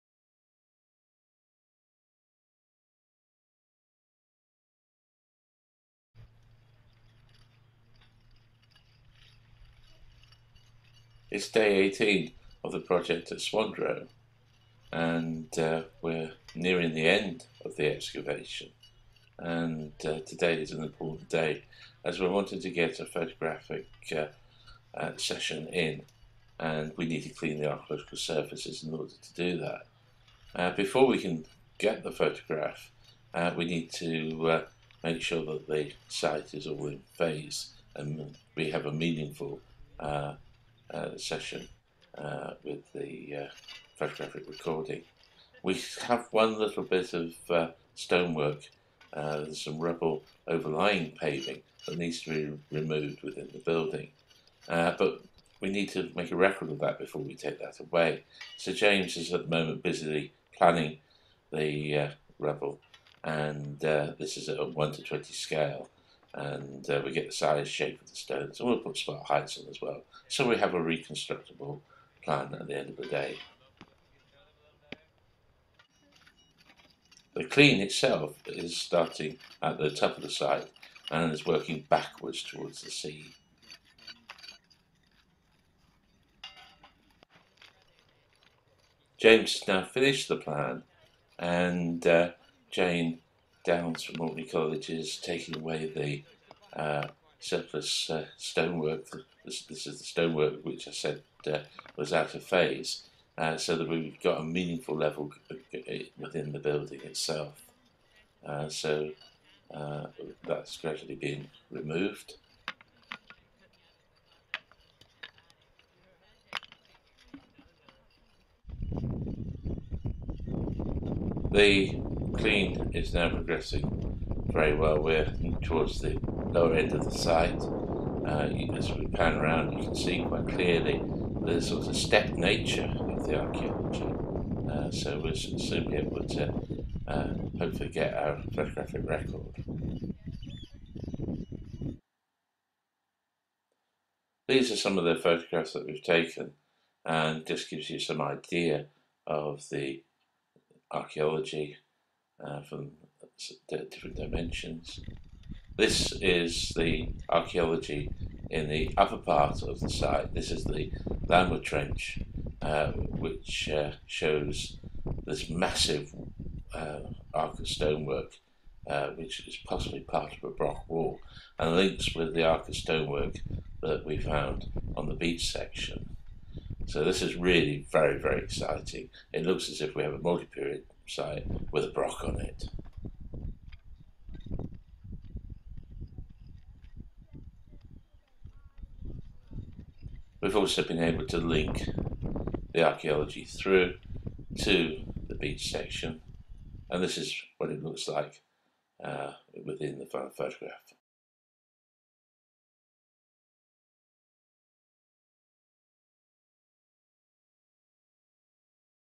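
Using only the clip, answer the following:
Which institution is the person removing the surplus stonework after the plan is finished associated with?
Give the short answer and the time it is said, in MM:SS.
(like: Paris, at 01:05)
Mulberry College, at 01:34.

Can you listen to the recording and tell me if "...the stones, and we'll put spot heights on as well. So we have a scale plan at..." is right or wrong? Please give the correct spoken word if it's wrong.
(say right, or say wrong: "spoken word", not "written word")
wrong: "reconstructable", not "scale".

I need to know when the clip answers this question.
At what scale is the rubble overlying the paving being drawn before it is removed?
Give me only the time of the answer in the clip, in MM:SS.
01:04.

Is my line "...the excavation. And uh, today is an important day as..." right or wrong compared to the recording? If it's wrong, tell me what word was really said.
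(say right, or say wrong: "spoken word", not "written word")
right.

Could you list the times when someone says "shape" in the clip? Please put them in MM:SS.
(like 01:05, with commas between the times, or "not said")
01:07.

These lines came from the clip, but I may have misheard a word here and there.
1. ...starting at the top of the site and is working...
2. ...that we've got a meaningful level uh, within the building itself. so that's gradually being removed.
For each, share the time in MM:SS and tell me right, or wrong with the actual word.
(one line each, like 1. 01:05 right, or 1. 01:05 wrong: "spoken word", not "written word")
1. 01:18 right
2. 01:43 right.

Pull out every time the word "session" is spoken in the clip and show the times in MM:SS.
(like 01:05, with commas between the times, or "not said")
00:25, 00:41.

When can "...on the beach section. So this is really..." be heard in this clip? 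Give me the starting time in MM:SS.
02:54.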